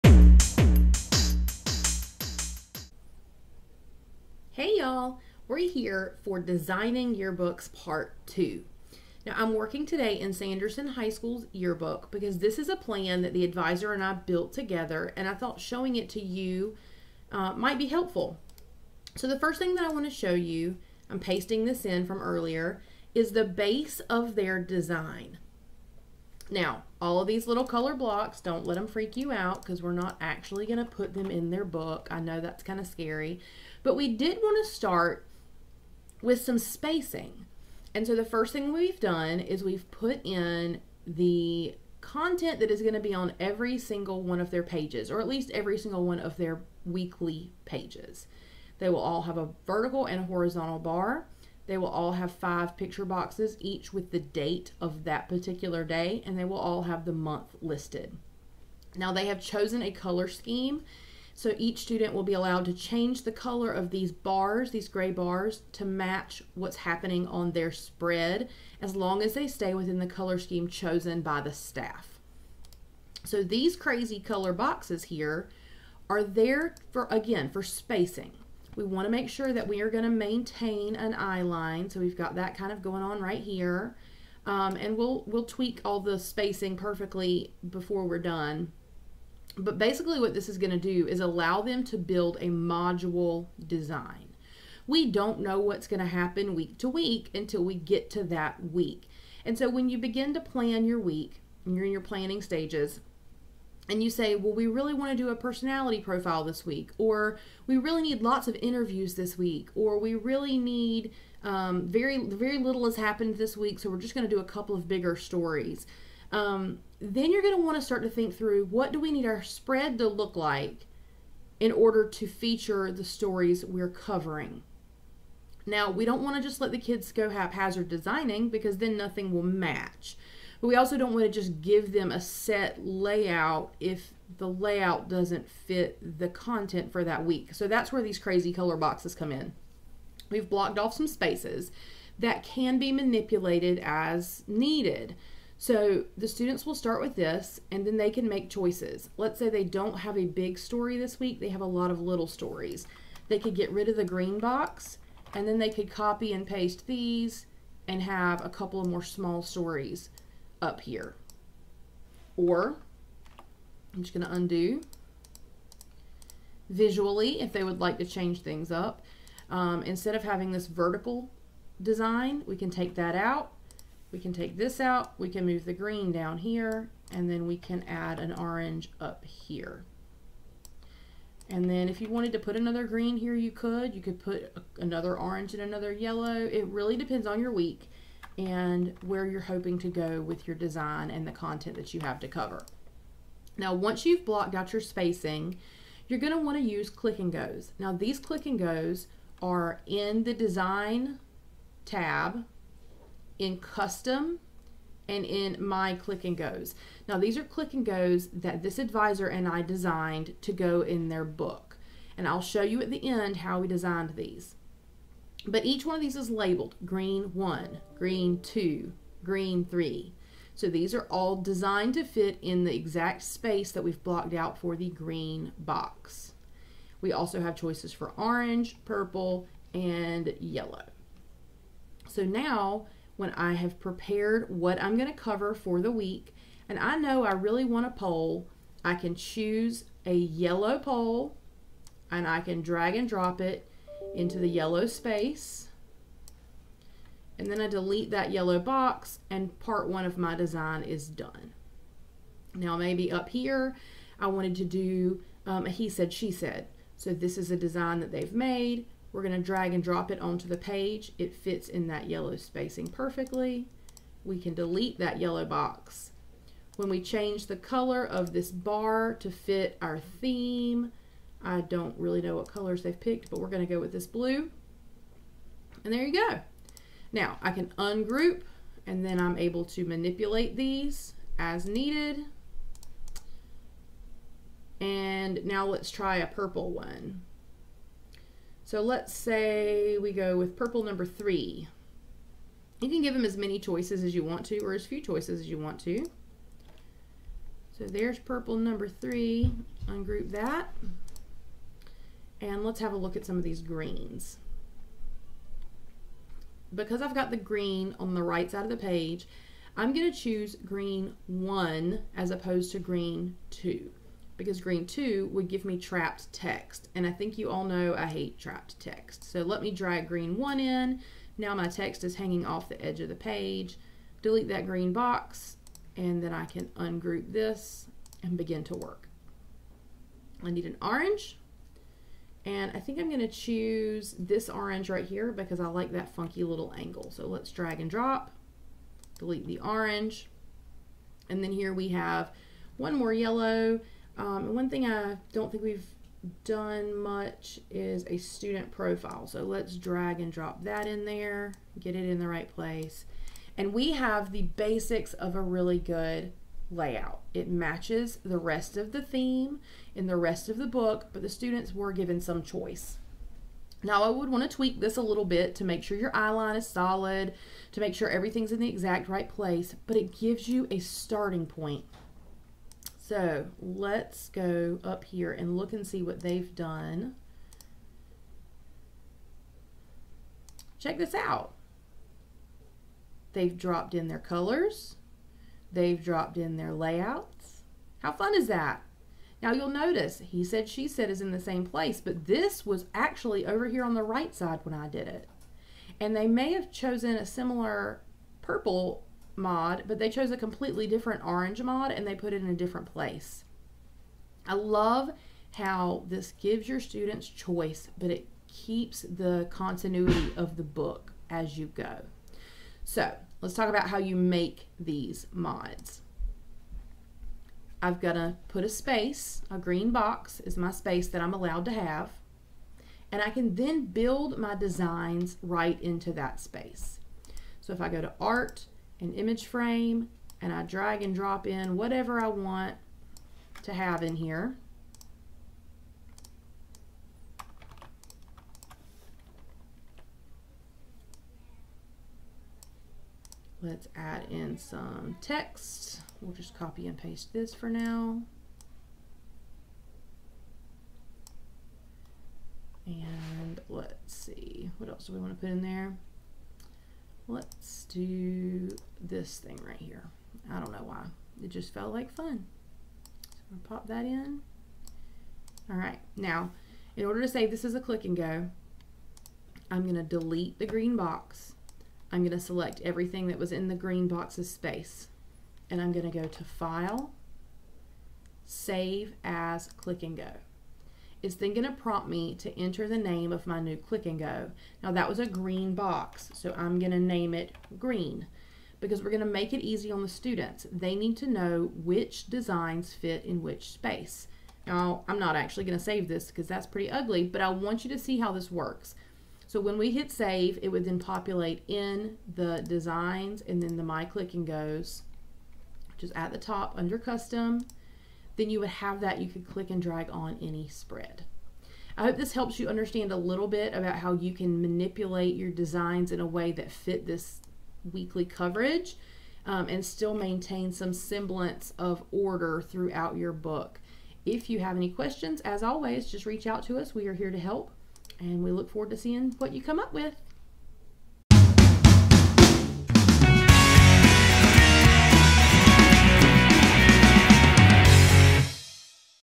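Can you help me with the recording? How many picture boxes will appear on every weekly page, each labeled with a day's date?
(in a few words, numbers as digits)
5.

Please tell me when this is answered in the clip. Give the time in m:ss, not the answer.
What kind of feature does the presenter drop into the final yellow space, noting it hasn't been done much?
5:48.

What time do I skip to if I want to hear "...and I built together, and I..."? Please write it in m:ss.
0:13.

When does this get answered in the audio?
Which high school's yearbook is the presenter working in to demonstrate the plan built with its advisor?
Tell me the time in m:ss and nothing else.
0:10.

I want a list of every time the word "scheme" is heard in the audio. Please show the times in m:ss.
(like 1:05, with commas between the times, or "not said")
1:00, 1:10.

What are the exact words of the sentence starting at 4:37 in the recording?
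Now, I can ungroup, and then I'm able to manipulate these as needed.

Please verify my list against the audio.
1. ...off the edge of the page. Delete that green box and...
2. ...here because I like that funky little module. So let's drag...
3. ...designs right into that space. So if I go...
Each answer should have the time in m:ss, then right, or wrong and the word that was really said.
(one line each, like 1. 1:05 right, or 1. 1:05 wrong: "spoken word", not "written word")
1. 5:22 right
2. 5:35 wrong: "angle", not "module"
3. 7:04 right.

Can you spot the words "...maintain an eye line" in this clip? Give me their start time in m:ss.
1:20.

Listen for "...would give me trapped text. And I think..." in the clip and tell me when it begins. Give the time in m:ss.
5:15.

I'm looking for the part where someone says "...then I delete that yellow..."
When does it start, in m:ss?
4:07.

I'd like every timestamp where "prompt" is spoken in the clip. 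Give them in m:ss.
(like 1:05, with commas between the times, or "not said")
8:01.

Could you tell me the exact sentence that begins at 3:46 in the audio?
We also have choices for orange, purple, and yellow.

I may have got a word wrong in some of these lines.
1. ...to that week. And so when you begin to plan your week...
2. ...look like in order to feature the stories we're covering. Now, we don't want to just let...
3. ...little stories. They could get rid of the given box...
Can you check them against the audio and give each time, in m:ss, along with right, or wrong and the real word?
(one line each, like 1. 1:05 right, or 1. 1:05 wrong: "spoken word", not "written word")
1. 1:38 right
2. 2:00 right
3. 2:31 wrong: "green", not "given".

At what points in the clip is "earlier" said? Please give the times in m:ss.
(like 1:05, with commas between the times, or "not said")
0:22.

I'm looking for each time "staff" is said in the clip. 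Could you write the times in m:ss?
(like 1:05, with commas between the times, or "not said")
1:11.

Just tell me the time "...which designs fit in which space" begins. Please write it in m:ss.
8:11.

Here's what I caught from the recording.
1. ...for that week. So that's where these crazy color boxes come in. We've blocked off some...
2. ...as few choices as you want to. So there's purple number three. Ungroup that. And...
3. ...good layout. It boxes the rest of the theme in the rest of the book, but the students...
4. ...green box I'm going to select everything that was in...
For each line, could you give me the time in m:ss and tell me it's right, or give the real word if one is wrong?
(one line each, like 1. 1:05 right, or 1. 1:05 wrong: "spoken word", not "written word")
1. 2:16 right
2. 4:54 right
3. 5:55 wrong: "matches", not "boxes"
4. 7:50 right.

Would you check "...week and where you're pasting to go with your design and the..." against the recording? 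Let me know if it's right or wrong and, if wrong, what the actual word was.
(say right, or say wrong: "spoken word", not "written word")
wrong: "hoping", not "pasting".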